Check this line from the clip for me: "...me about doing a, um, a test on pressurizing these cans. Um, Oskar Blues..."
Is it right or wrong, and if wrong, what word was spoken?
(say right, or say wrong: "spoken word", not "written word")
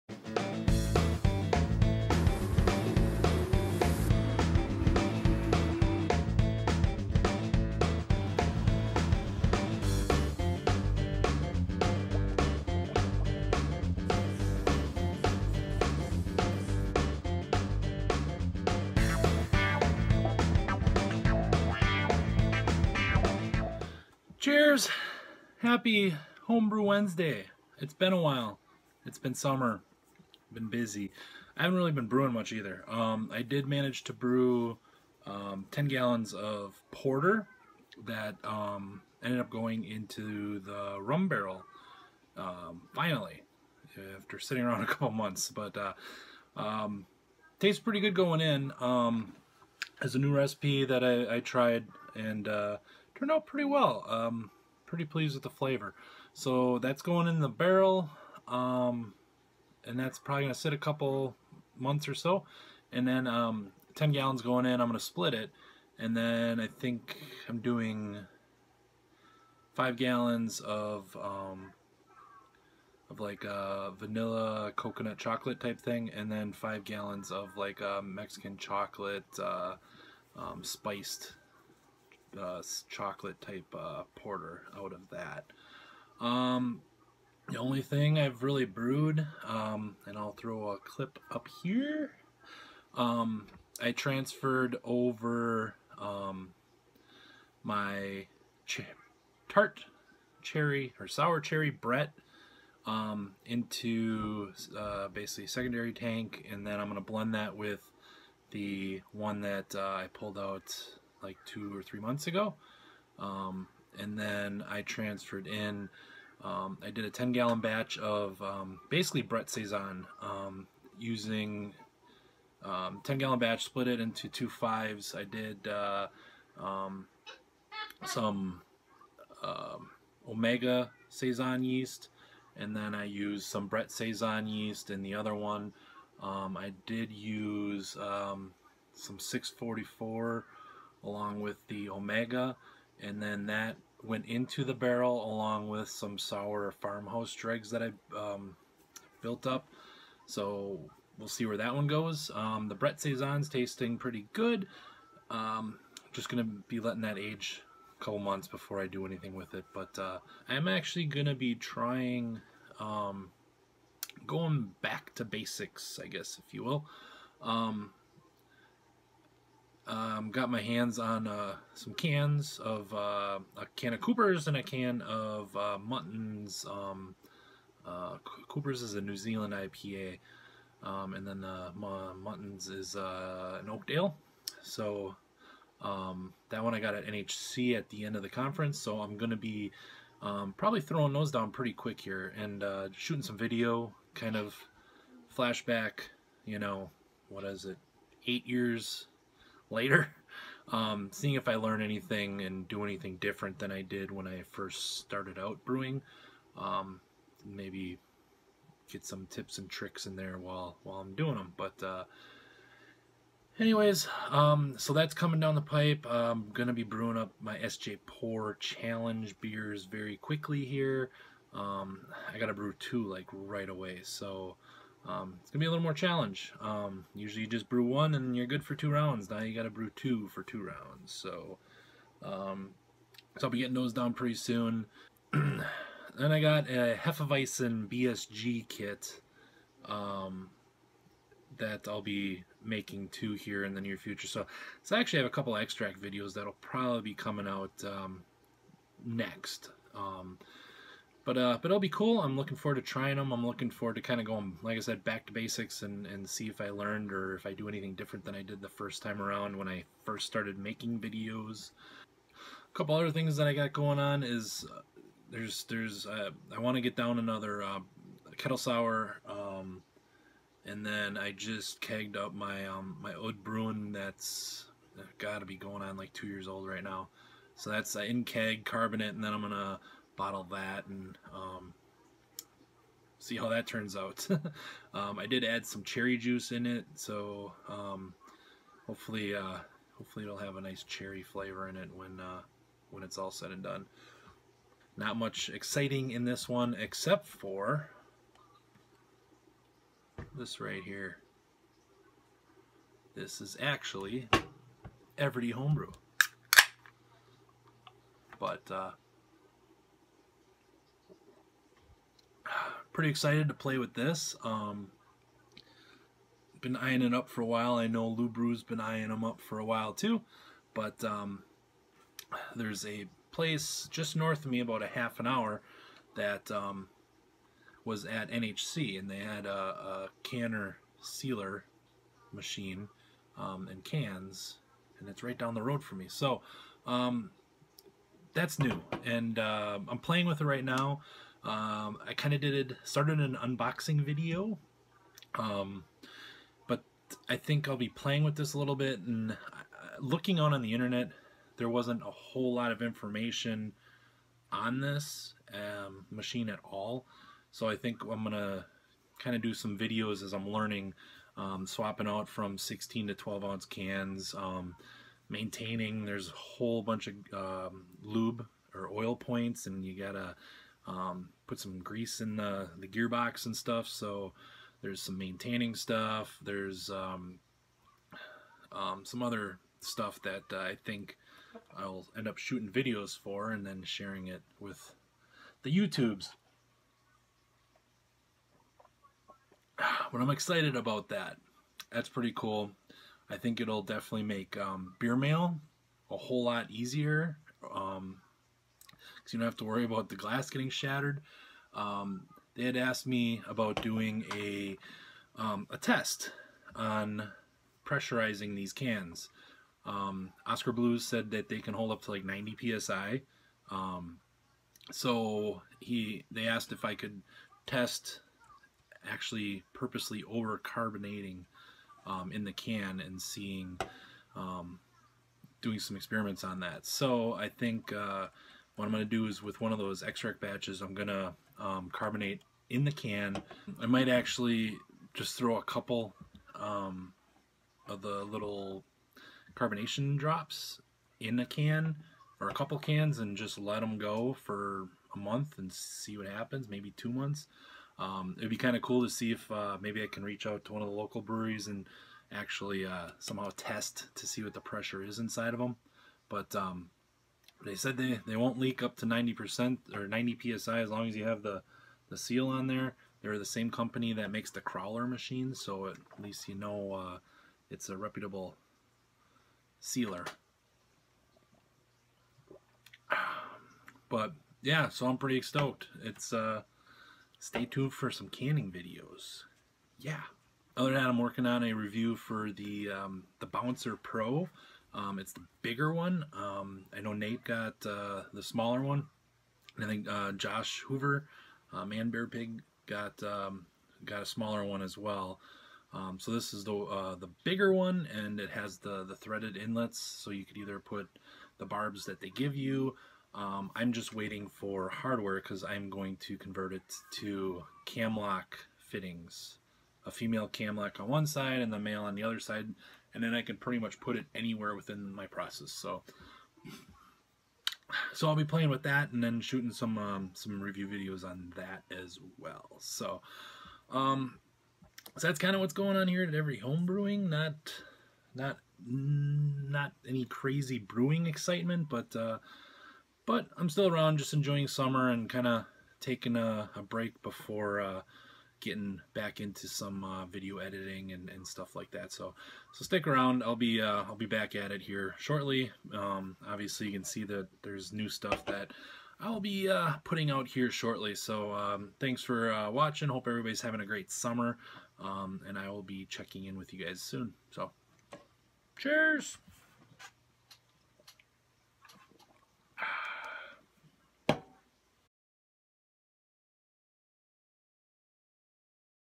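right.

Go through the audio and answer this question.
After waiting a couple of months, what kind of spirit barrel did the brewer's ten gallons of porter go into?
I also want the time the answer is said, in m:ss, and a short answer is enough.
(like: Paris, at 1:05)
Rum, at 0:40.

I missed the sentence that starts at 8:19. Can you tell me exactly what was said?
So you could either put the barbs that they give you.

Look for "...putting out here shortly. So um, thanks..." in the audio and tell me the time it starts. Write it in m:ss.
9:10.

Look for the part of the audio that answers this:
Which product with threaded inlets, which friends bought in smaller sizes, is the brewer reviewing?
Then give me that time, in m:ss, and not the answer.
8:03.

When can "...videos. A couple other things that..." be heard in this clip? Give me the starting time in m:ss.
4:20.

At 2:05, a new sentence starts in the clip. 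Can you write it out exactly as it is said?
I did uh, um, some uh, Omega Saison yeast, and then I used some Brett Saison yeast and the other one.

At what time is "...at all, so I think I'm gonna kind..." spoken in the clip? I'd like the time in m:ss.
5:56.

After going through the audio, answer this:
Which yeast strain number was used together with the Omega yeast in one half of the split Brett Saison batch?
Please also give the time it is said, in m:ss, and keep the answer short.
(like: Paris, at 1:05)
644, at 2:18.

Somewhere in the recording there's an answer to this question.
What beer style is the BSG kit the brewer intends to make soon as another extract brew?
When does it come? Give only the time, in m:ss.
3:57.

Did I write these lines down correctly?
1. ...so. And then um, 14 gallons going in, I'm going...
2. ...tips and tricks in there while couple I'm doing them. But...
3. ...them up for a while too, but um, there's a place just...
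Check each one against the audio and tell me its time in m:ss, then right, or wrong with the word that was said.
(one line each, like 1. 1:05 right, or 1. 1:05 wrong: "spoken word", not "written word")
1. 1:02 wrong: "10", not "14"
2. 3:29 wrong: "while", not "couple"
3. 5:19 right.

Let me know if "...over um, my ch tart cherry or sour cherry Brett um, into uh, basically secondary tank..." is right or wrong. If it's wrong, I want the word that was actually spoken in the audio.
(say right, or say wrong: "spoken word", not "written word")
right.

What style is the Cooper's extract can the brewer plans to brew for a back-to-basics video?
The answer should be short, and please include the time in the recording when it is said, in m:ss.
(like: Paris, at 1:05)
New Zealand IPA, at 2:59.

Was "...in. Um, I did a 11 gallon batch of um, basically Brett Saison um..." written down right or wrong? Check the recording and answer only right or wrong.
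wrong.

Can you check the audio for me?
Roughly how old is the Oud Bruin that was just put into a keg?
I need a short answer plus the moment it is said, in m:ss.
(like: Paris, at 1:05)
2 years, at 4:36.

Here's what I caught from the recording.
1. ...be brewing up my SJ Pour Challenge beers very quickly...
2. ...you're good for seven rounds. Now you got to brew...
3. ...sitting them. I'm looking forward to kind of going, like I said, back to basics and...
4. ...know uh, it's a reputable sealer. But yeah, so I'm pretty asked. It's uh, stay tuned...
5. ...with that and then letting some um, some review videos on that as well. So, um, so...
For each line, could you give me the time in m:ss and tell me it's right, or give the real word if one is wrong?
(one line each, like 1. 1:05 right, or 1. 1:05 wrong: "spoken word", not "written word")
1. 3:36 right
2. 3:48 wrong: "two", not "seven"
3. 4:12 wrong: "trying", not "sitting"
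4. 7:46 wrong: "stoked", not "asked"
5. 8:38 wrong: "shooting", not "letting".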